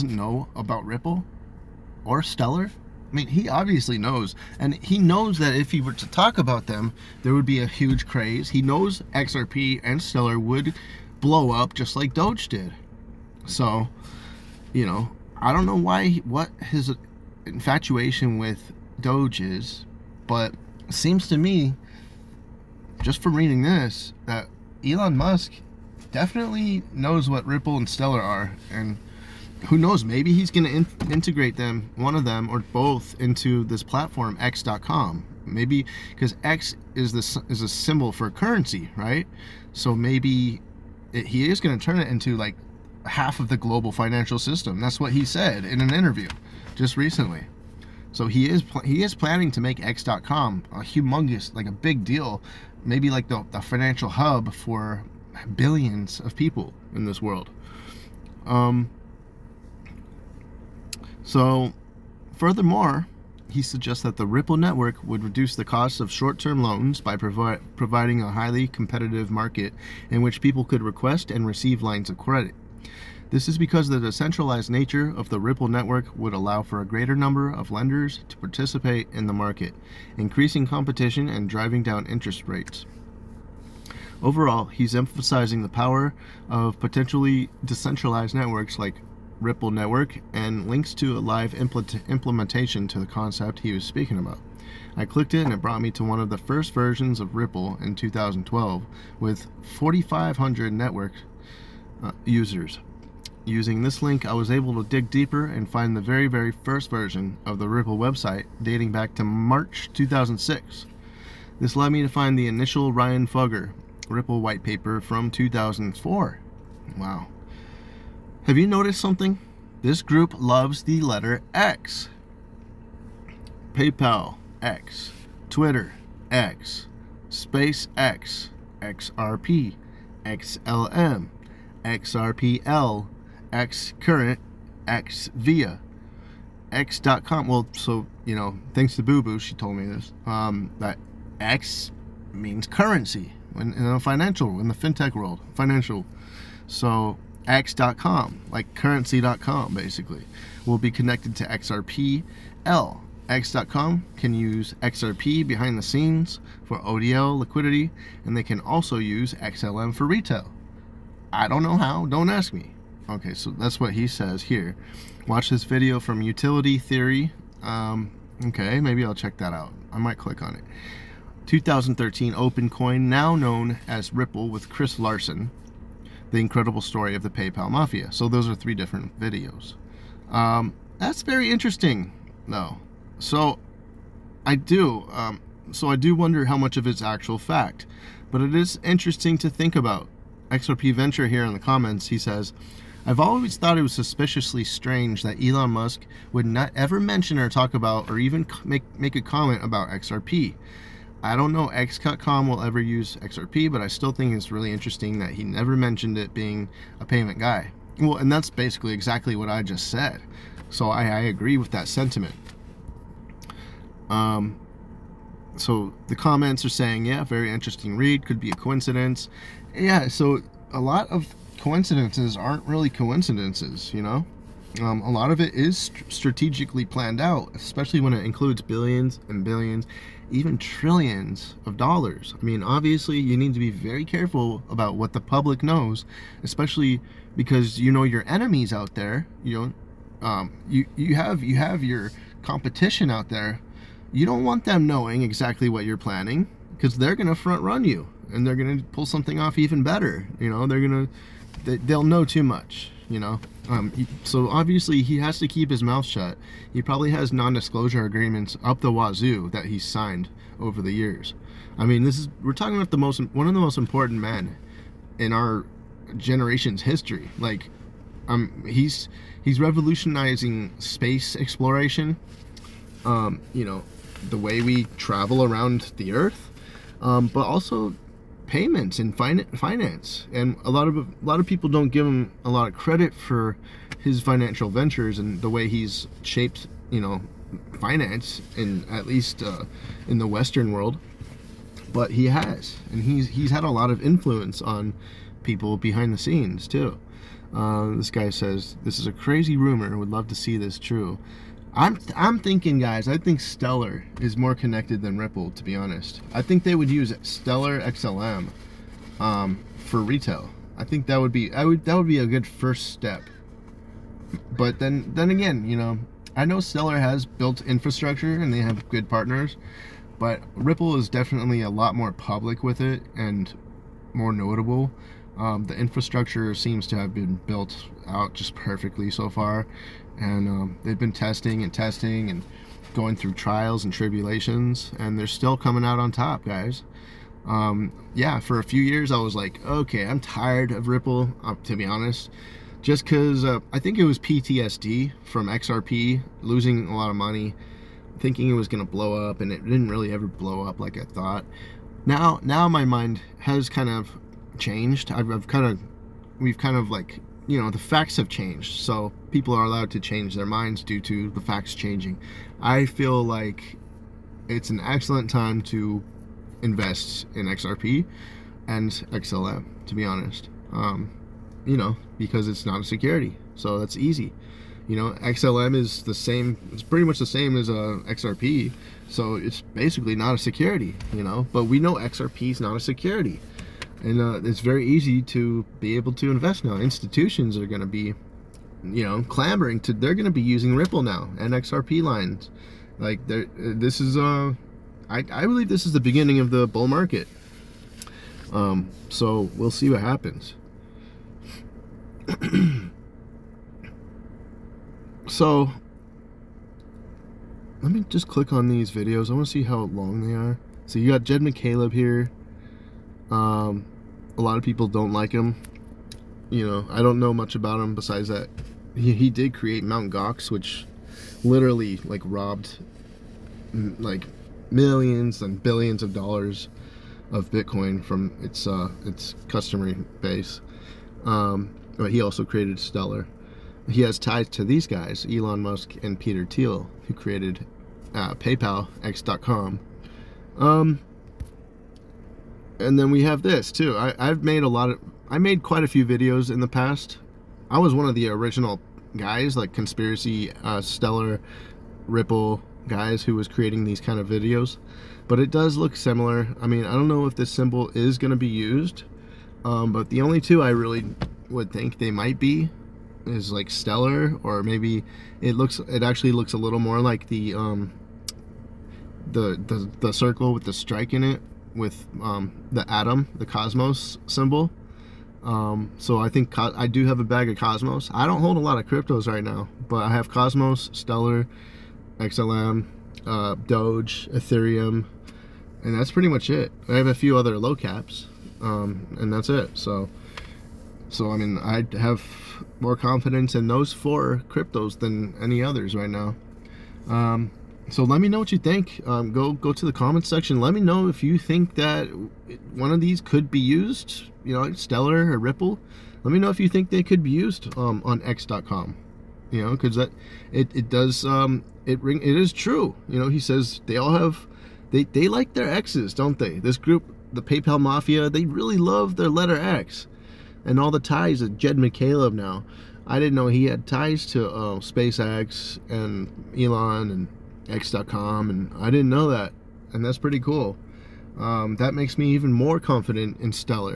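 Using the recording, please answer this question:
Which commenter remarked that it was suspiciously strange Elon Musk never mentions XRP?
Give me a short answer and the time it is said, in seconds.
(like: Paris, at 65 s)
XRP Venture, at 190 s.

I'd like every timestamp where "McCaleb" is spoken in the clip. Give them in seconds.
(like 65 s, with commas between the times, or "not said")
411 s, 521 s.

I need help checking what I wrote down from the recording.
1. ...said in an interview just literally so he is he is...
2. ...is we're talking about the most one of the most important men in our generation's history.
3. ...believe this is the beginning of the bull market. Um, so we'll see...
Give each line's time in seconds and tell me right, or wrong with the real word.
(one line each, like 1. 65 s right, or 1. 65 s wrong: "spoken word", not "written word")
1. 45 s wrong: "recently", not "literally"
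2. 262 s right
3. 395 s right.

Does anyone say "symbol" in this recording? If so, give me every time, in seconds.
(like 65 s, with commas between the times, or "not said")
37 s, 457 s, 474 s.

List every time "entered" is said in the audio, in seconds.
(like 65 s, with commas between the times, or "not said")
not said.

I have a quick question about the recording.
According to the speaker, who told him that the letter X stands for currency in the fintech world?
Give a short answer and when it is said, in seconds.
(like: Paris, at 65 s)
Boo Boo, at 139 s.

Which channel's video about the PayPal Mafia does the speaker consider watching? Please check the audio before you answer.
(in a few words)
Utility Theory.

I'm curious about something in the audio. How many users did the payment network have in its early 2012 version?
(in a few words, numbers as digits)
4,500.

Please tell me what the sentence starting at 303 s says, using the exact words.
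I think Stellar is more connected than Ripple, to be honest.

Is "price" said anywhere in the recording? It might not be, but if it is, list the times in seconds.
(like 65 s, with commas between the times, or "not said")
not said.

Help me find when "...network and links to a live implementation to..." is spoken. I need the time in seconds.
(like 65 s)
89 s.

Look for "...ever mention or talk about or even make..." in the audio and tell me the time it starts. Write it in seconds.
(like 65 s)
196 s.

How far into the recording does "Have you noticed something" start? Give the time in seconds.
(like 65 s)
118 s.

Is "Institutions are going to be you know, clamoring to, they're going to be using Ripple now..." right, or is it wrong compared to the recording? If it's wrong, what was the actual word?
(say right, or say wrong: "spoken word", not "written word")
right.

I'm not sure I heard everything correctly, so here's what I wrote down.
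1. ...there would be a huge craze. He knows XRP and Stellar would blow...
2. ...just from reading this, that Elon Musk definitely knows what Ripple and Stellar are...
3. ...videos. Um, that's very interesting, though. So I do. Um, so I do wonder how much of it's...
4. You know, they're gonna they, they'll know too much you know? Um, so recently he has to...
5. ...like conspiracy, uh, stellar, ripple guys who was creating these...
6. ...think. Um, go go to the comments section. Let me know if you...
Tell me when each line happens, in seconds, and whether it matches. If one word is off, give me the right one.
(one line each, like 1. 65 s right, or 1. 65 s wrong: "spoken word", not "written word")
1. 7 s right
2. 23 s right
3. 179 s right
4. 250 s wrong: "obviously", not "recently"
5. 449 s right
6. 498 s right.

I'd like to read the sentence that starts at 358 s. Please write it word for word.
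So people are allowed to change their minds due to the facts changing.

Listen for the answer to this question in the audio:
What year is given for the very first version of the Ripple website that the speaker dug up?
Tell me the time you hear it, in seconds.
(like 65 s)
109 s.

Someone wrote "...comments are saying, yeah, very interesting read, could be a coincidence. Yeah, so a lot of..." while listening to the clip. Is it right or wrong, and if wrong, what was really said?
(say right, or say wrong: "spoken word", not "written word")
right.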